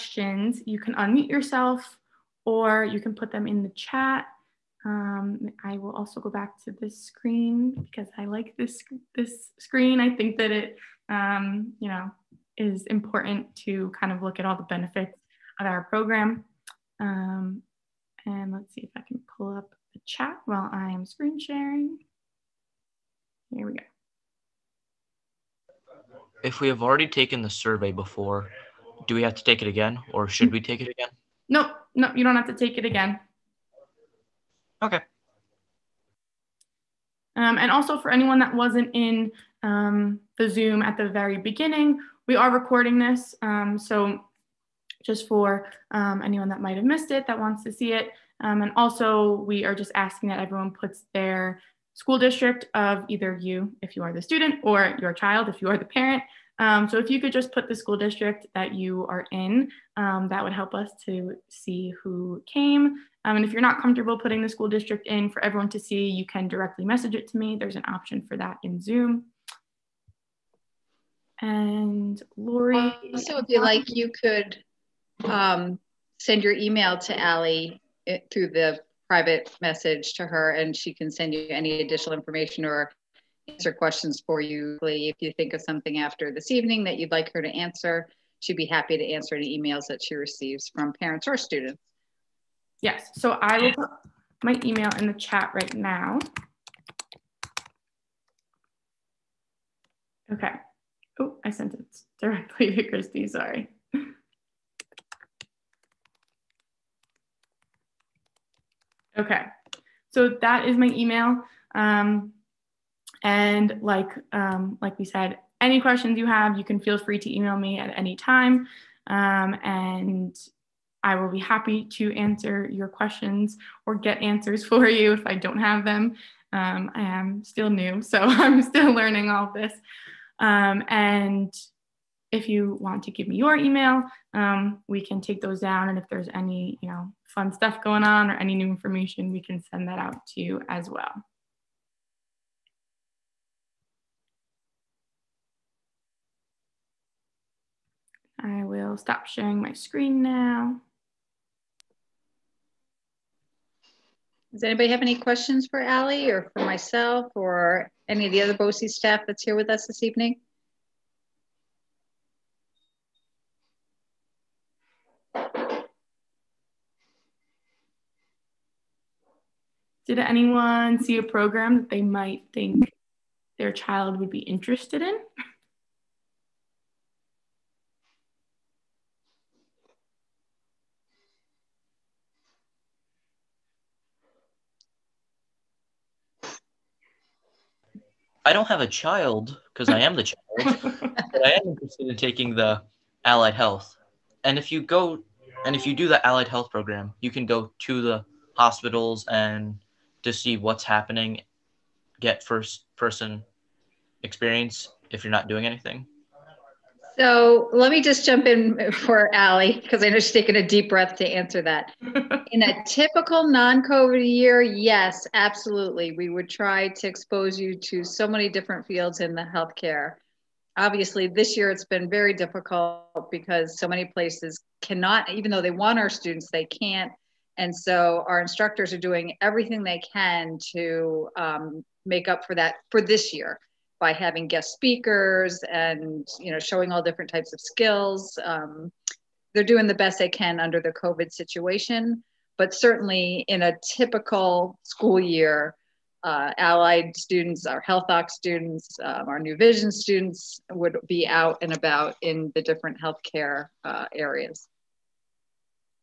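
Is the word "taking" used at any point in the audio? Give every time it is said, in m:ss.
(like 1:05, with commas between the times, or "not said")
3:12, 3:30.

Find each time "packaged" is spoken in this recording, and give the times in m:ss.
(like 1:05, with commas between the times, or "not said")
not said.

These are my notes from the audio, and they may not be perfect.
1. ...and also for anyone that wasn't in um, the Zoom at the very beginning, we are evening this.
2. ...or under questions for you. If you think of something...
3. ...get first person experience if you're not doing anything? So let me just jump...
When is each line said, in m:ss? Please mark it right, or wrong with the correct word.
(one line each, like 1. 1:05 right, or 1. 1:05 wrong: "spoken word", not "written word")
1. 0:37 wrong: "recording", not "evening"
2. 1:22 wrong: "answer", not "under"
3. 3:22 right.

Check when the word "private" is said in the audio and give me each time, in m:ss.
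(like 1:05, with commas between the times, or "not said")
1:19.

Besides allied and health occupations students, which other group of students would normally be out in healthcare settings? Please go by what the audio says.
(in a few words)
New Vision.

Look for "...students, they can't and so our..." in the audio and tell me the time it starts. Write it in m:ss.
3:46.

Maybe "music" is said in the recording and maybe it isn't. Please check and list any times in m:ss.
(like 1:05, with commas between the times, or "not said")
not said.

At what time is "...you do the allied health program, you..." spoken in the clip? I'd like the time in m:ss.
3:15.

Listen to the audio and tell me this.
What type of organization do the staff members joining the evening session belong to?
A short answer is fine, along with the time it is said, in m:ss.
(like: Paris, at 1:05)
BOCES, at 2:38.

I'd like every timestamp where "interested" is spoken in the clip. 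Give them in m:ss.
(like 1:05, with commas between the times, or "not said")
2:54, 3:11.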